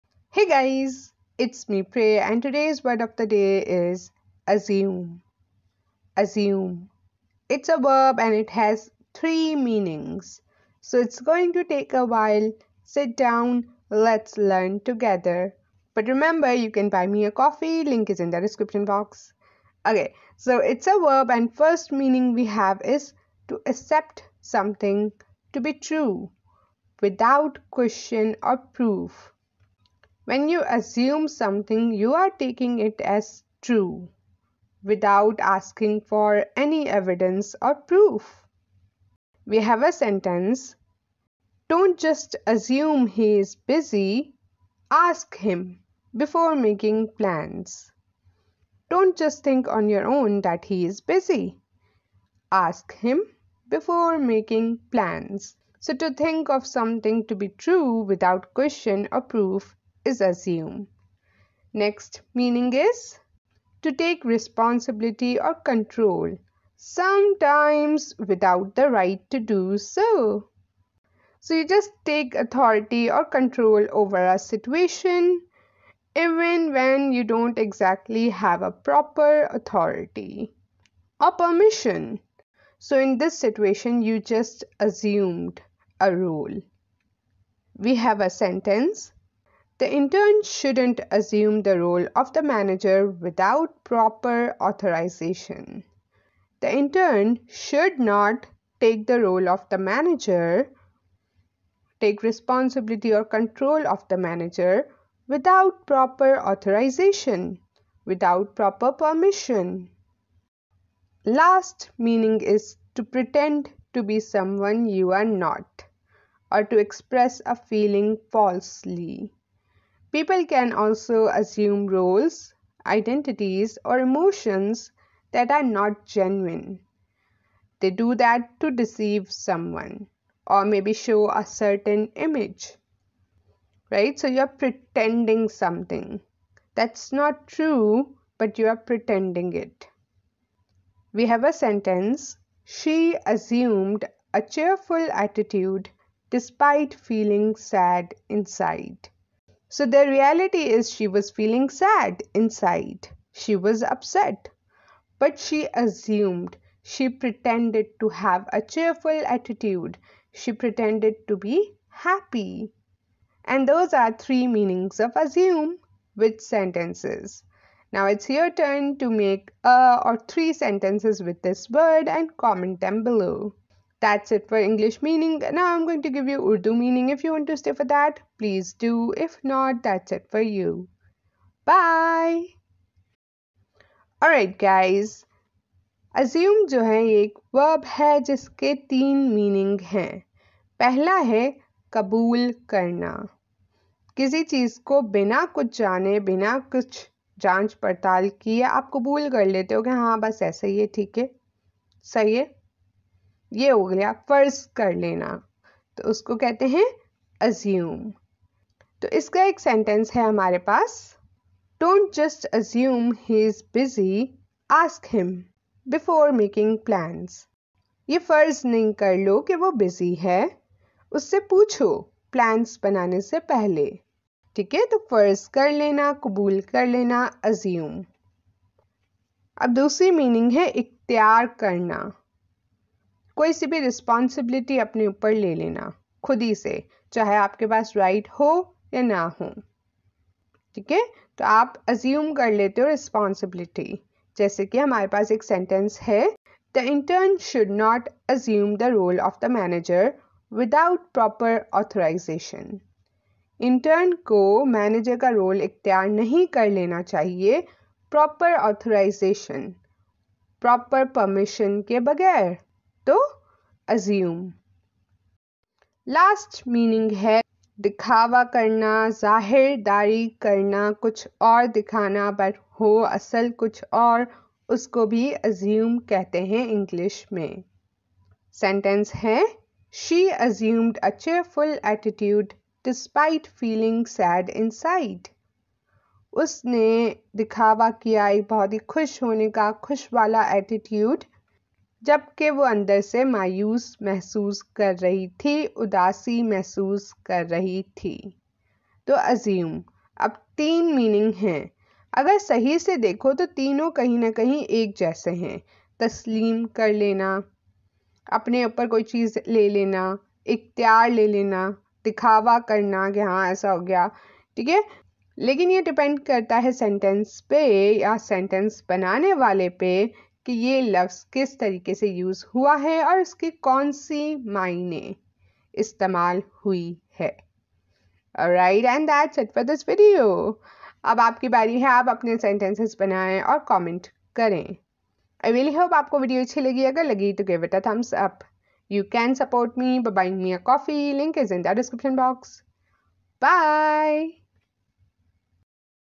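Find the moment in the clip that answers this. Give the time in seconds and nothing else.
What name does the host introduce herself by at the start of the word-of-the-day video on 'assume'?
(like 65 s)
1 s.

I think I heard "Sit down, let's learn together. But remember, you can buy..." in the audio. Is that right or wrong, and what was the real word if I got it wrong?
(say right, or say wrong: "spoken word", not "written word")
right.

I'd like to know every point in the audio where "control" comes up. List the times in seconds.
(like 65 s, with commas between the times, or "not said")
65 s, 73 s, 103 s.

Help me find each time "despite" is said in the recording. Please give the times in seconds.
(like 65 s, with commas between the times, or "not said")
146 s.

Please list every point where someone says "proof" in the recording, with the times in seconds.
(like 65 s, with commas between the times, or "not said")
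28 s, 37 s, 59 s.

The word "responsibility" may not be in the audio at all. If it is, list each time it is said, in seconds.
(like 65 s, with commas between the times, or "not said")
64 s, 102 s.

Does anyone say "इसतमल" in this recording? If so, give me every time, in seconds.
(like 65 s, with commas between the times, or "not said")
325 s.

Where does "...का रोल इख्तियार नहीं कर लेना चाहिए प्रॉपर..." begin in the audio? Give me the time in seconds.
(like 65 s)
255 s.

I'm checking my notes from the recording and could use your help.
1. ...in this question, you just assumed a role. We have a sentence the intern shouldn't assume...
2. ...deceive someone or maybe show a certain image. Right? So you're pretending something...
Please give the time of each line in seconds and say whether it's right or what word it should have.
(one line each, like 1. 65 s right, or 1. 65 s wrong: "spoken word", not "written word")
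1. 82 s wrong: "situation", not "question"
2. 128 s right.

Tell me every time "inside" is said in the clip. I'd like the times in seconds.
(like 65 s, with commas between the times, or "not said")
148 s, 152 s.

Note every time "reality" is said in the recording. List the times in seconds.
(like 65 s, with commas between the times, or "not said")
150 s.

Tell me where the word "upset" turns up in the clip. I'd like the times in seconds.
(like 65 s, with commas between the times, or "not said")
153 s.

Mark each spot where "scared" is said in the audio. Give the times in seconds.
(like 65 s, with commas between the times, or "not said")
not said.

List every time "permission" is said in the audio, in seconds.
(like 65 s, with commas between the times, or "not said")
81 s, 108 s.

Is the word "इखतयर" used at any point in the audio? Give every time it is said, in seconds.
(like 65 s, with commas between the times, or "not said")
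230 s, 255 s, 310 s.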